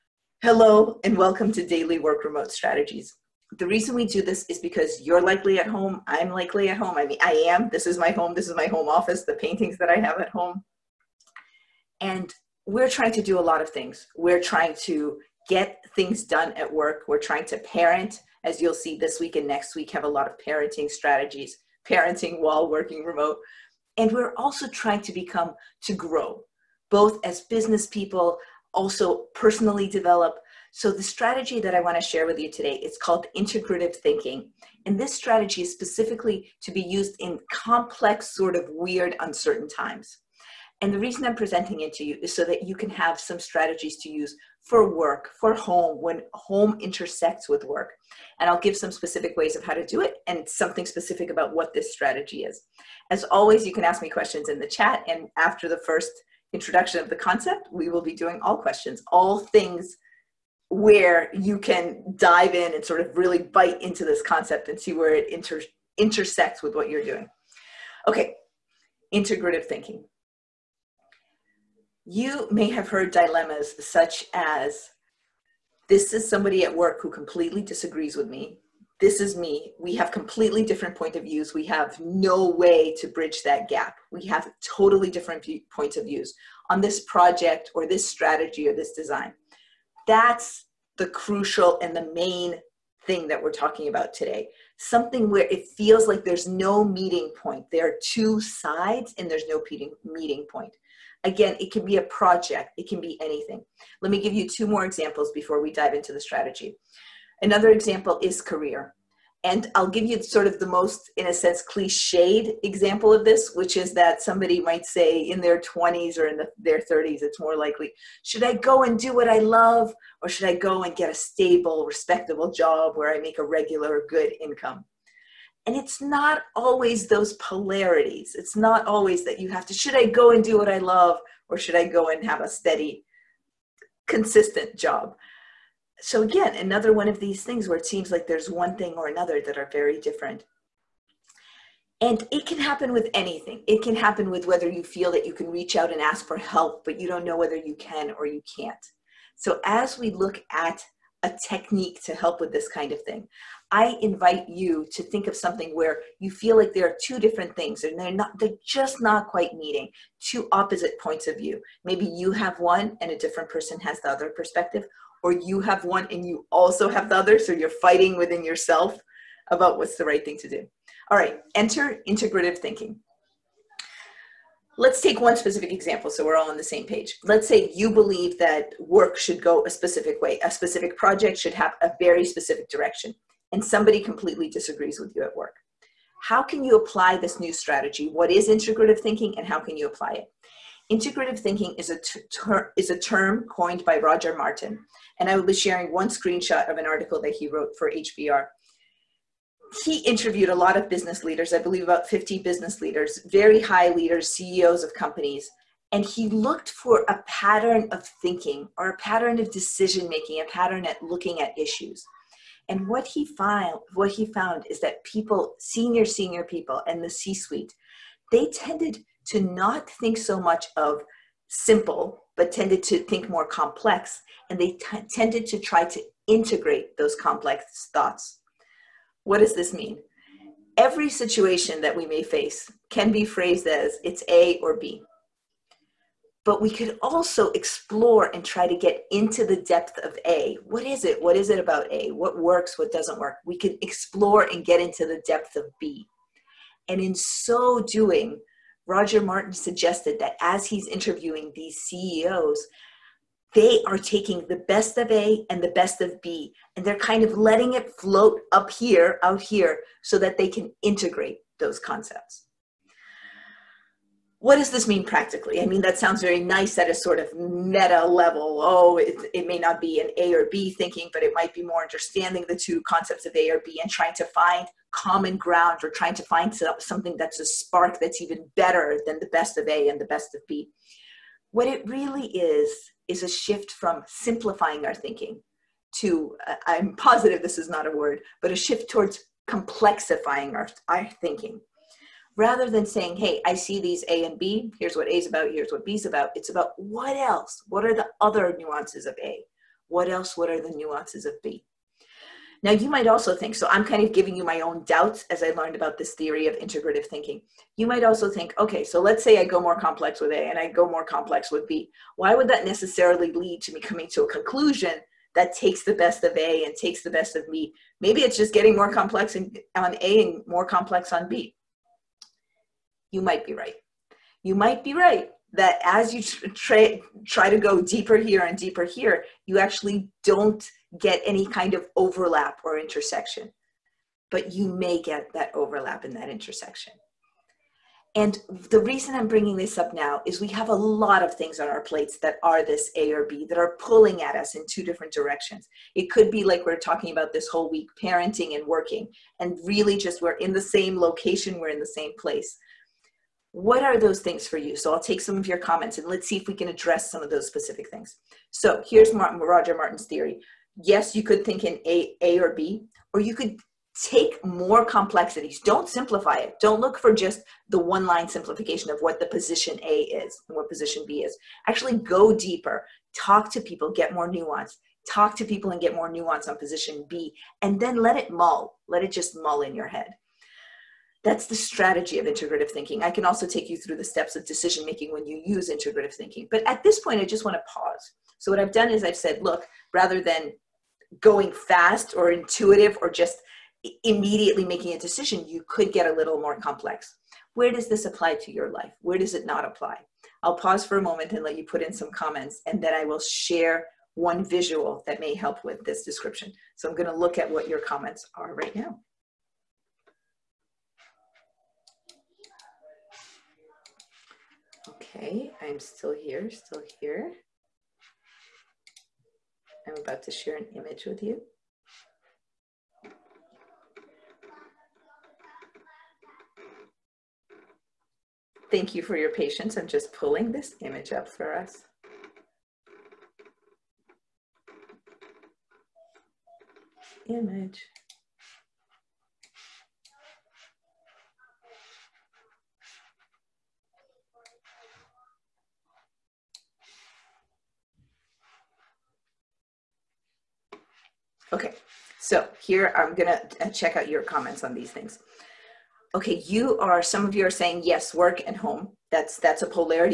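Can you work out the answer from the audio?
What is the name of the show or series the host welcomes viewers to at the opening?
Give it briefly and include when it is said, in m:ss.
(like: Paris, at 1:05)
Daily Work Remote Strategies, at 0:01.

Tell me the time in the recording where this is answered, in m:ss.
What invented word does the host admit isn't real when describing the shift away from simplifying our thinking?
4:49.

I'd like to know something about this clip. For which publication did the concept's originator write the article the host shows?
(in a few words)
HBR.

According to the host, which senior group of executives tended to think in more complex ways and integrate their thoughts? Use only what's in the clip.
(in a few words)
the C-suite.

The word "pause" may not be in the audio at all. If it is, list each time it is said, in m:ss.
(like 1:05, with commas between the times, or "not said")
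6:27, 6:40.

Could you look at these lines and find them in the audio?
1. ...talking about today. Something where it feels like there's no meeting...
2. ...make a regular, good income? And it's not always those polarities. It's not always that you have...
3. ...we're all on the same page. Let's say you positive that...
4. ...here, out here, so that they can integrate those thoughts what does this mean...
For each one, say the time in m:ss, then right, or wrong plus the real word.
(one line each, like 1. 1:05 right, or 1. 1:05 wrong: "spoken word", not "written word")
1. 1:33 right
2. 2:03 right
3. 2:56 wrong: "believe", not "positive"
4. 4:18 wrong: "concepts", not "thoughts".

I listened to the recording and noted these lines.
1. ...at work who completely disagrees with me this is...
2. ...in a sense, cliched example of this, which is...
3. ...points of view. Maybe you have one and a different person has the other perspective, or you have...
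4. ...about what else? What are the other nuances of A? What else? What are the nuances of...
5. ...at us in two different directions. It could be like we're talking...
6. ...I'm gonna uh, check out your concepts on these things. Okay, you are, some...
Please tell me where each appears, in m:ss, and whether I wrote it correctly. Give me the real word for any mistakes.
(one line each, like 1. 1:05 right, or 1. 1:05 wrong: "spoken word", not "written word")
1. 1:16 right
2. 1:51 right
3. 2:41 right
4. 4:56 right
5. 5:44 right
6. 7:32 wrong: "comments", not "concepts".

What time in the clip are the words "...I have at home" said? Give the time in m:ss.
0:09.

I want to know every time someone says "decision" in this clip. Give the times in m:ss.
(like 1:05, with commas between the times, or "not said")
3:29, 6:24, 6:34.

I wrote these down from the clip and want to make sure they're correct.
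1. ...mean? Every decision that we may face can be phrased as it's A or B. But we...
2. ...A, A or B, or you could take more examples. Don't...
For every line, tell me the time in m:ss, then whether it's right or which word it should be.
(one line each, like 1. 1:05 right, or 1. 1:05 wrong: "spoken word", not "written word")
1. 3:49 wrong: "situation", not "decision"
2. 6:01 wrong: "complexities", not "examples".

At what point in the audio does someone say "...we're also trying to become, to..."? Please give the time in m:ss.
0:24.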